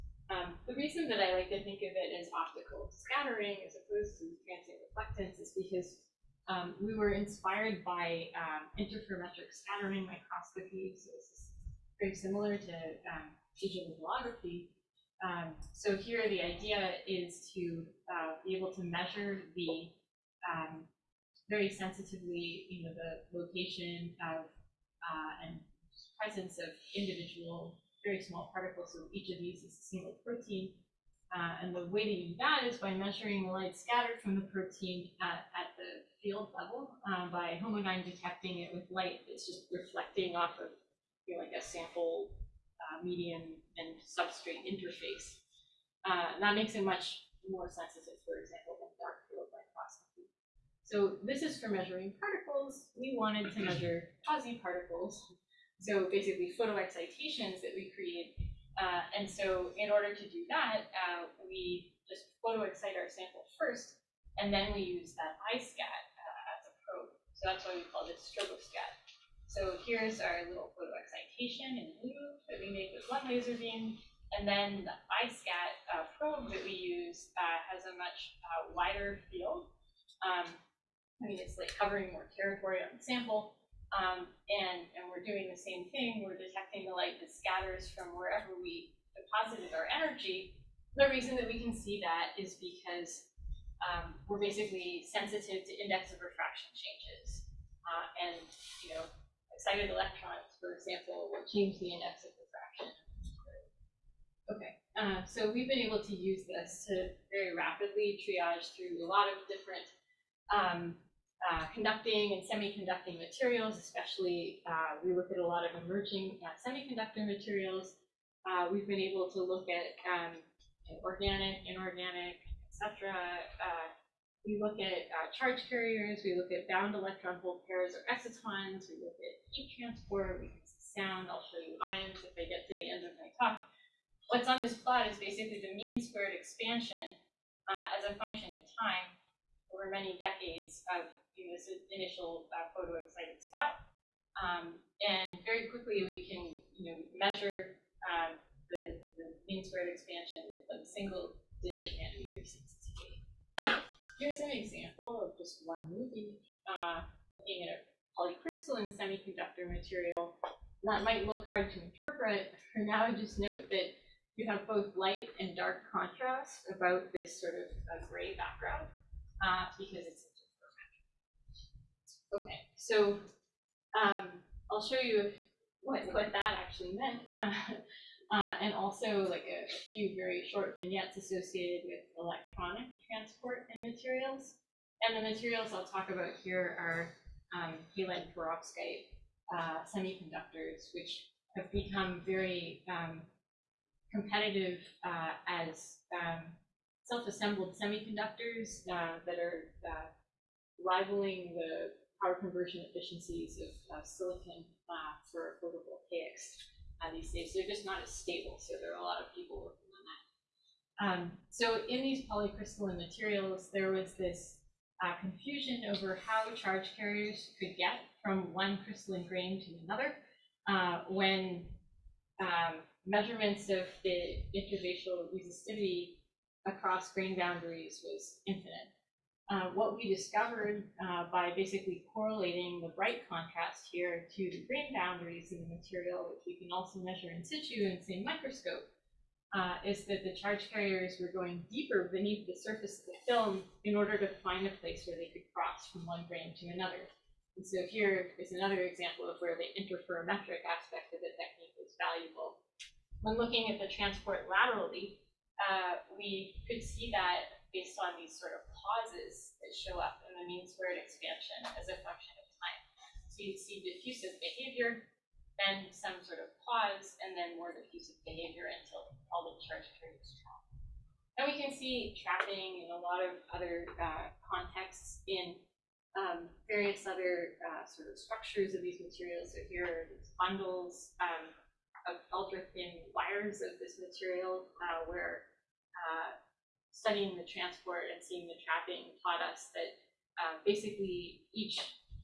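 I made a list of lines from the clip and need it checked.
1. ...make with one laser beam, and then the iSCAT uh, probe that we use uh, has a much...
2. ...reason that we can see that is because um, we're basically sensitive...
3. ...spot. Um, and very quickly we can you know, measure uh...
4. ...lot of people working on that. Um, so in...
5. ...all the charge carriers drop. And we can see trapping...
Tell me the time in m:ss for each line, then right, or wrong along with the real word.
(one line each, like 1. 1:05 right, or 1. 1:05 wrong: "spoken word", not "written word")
1. 1:12 right
2. 1:31 right
3. 2:23 right
4. 3:29 right
5. 4:29 right.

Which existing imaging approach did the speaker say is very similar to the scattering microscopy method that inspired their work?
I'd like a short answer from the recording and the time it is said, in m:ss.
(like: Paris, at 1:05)
Digital holography, at 0:13.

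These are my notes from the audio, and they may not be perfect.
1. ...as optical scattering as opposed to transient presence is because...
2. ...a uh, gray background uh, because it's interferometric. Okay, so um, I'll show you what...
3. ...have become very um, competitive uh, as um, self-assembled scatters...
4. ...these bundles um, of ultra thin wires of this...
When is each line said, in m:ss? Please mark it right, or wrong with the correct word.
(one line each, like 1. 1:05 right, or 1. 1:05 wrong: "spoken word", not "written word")
1. 0:02 wrong: "reflectance", not "presence"
2. 2:47 right
3. 3:11 wrong: "semiconductors", not "scatters"
4. 4:40 right.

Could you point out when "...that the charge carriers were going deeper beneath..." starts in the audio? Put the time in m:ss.
4:00.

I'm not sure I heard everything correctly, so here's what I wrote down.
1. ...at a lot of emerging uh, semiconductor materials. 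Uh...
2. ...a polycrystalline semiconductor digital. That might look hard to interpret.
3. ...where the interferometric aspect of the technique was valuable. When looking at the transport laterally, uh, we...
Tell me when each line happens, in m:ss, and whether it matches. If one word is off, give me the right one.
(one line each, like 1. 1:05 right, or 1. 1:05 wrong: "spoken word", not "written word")
1. 1:55 right
2. 2:37 wrong: "material", not "digital"
3. 4:09 right.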